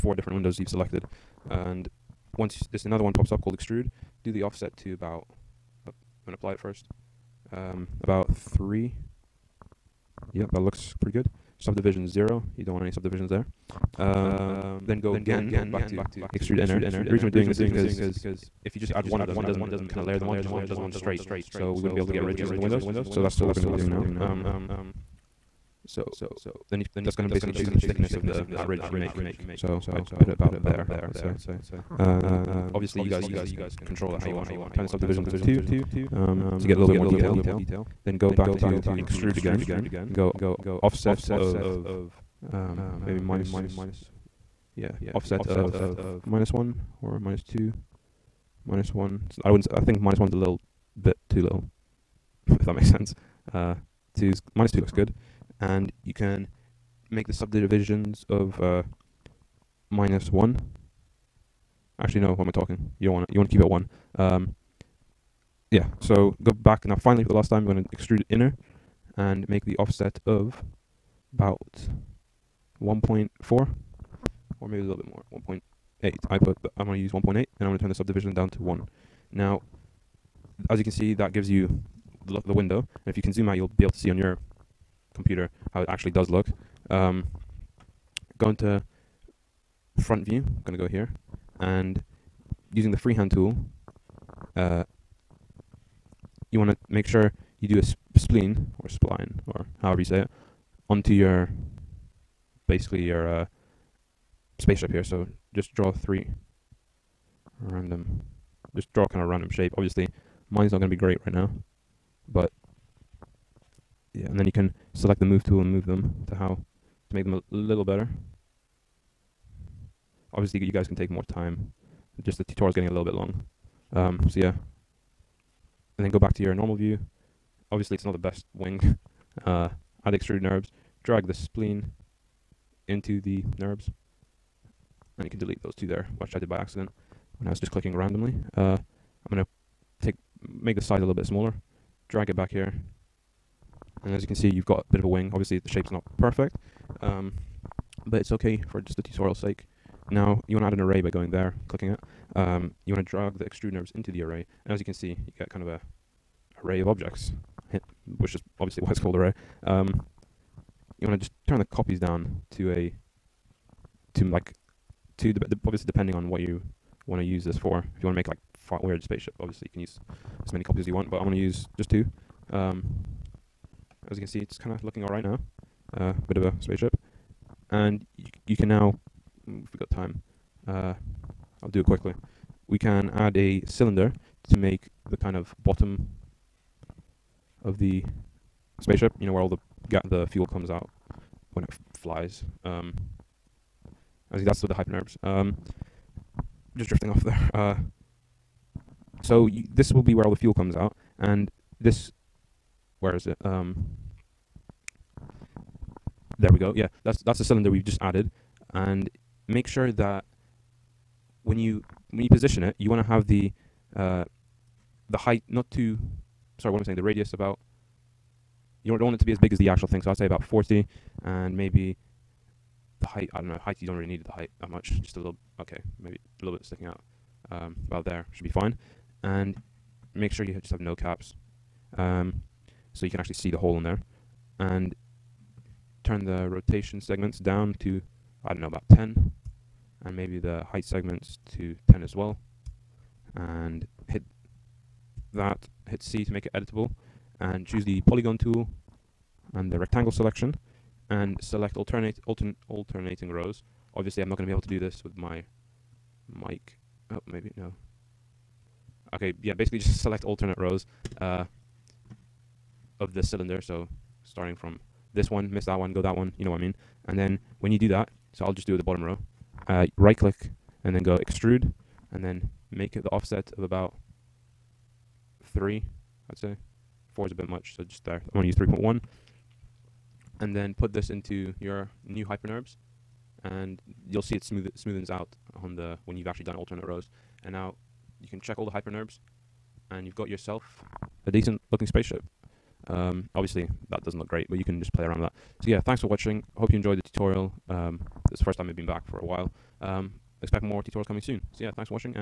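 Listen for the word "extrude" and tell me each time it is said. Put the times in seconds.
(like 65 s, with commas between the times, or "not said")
3 s, 16 s, 38 s, 67 s, 130 s, 153 s, 271 s.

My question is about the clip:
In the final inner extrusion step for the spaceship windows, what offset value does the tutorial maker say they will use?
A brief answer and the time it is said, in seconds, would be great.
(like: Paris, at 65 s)
1.8, at 76 s.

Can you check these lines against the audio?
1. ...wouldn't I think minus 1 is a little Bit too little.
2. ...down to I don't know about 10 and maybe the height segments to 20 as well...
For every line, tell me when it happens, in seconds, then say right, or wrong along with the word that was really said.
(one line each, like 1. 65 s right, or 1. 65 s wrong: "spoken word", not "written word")
1. 49 s right
2. 237 s wrong: "10", not "20".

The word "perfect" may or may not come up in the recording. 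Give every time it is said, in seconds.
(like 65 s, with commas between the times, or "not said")
146 s.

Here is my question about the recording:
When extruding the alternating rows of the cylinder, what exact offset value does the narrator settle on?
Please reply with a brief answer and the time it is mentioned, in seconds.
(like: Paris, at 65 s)
3.1, at 278 s.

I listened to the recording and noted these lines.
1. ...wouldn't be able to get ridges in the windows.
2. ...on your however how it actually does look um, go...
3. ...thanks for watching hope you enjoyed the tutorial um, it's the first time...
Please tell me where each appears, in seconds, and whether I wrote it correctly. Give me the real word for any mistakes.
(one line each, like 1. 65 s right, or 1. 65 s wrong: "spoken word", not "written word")
1. 21 s right
2. 84 s wrong: "computer", not "however"
3. 295 s right.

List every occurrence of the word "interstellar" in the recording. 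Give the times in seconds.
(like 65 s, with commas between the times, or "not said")
not said.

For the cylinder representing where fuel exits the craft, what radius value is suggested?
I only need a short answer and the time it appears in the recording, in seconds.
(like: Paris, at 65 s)
40, at 220 s.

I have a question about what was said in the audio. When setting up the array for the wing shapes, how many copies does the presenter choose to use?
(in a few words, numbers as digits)
2.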